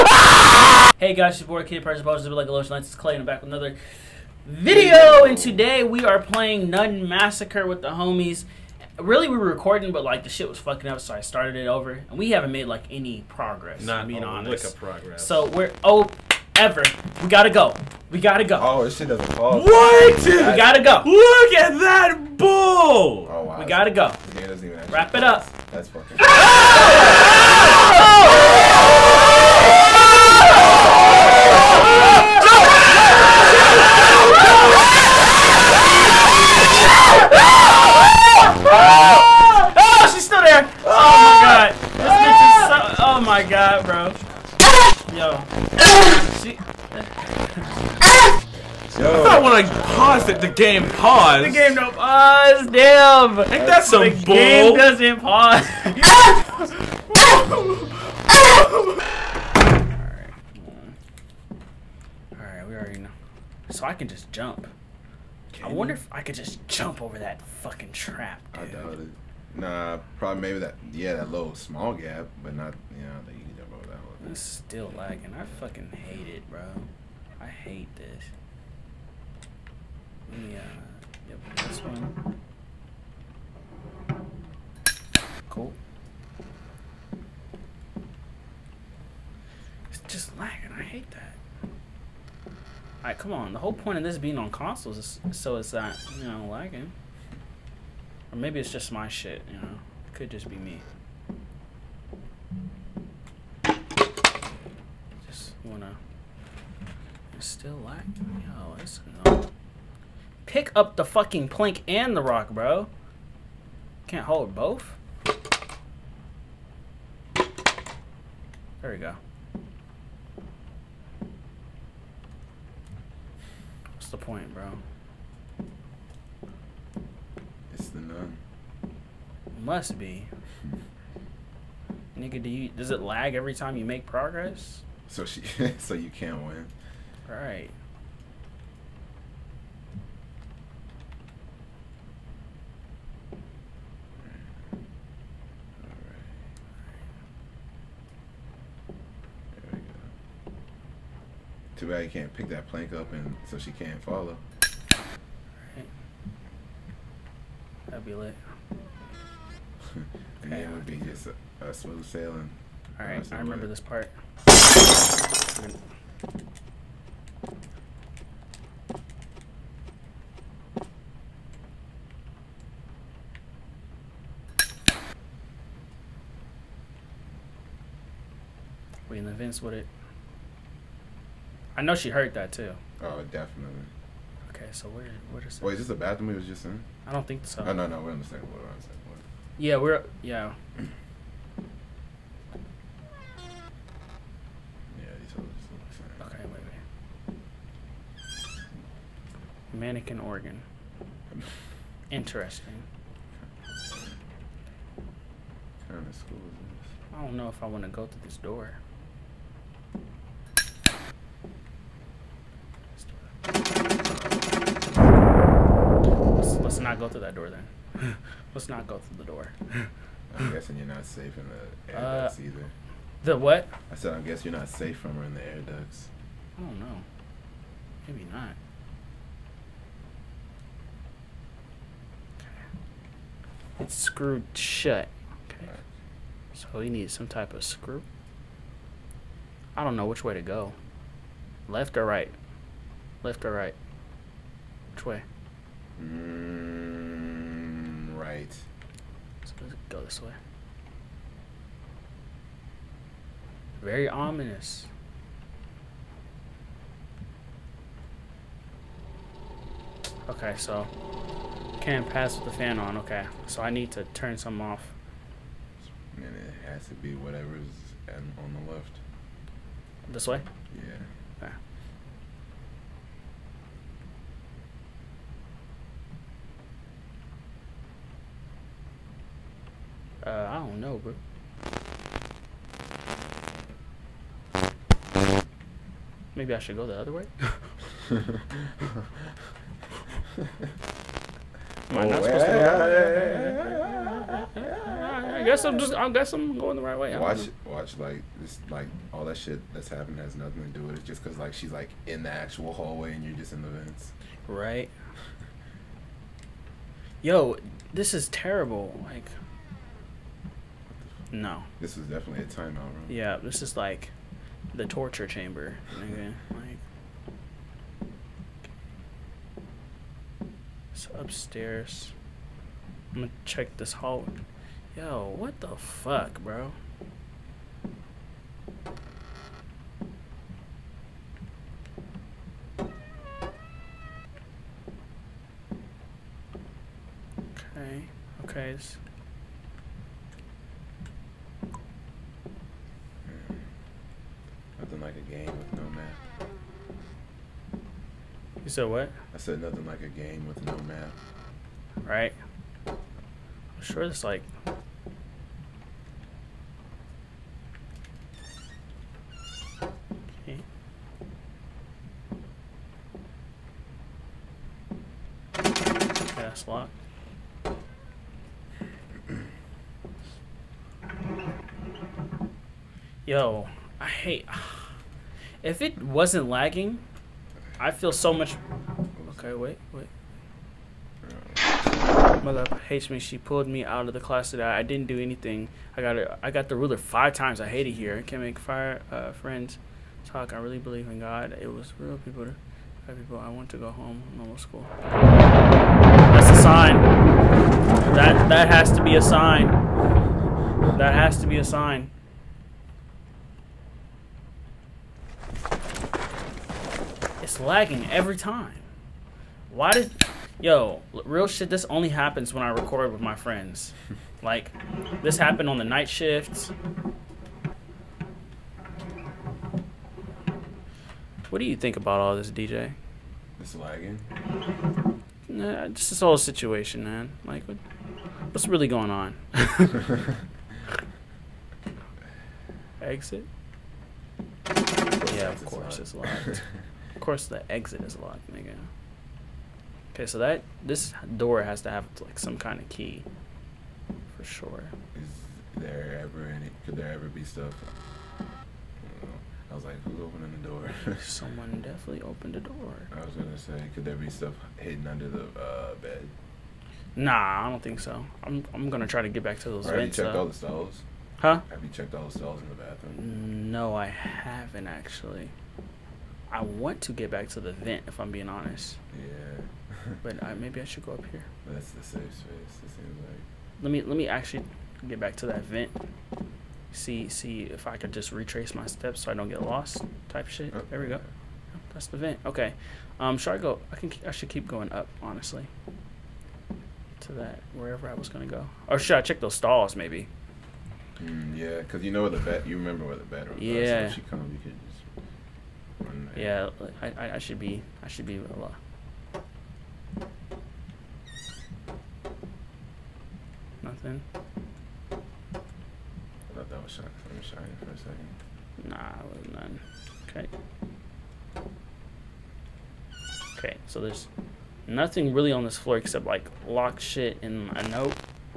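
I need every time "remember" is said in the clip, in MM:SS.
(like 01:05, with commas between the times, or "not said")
02:43, 08:12.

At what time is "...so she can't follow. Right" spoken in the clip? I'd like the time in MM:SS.
02:33.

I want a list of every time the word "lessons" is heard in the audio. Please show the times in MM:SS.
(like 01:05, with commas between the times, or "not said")
not said.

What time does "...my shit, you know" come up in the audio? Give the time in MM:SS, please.
01:38.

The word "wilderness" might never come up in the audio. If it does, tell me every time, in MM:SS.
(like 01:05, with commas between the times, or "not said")
not said.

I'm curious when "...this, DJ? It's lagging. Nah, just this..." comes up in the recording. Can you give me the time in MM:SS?
07:02.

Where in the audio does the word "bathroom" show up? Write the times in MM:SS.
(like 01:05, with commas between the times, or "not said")
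03:05, 07:42.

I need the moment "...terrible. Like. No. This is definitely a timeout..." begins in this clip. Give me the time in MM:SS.
05:08.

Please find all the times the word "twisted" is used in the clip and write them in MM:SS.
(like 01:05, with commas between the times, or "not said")
not said.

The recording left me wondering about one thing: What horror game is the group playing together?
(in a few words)
Nun Massacre.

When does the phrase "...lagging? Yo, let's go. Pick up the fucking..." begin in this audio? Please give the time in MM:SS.
01:47.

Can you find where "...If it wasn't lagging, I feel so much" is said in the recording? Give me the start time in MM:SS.
06:15.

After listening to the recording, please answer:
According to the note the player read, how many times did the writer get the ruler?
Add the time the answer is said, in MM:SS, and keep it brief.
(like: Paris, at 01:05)
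5, at 06:26.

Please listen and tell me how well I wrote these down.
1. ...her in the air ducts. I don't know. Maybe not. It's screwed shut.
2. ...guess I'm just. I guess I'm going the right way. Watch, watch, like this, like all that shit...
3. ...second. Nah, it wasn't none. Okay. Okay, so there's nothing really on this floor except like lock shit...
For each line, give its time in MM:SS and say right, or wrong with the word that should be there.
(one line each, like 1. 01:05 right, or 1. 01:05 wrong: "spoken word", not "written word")
1. 03:45 right
2. 04:55 right
3. 08:27 right.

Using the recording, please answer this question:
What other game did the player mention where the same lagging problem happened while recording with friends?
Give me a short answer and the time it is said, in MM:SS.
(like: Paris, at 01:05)
night shift, at 06:55.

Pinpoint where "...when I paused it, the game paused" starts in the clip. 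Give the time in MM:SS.
00:49.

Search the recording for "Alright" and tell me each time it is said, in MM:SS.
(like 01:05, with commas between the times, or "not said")
00:55, 01:02, 01:33, 02:42.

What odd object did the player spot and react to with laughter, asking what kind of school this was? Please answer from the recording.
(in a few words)
Mannequin organ.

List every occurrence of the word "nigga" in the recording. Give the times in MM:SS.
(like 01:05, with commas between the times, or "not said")
02:12, 07:18.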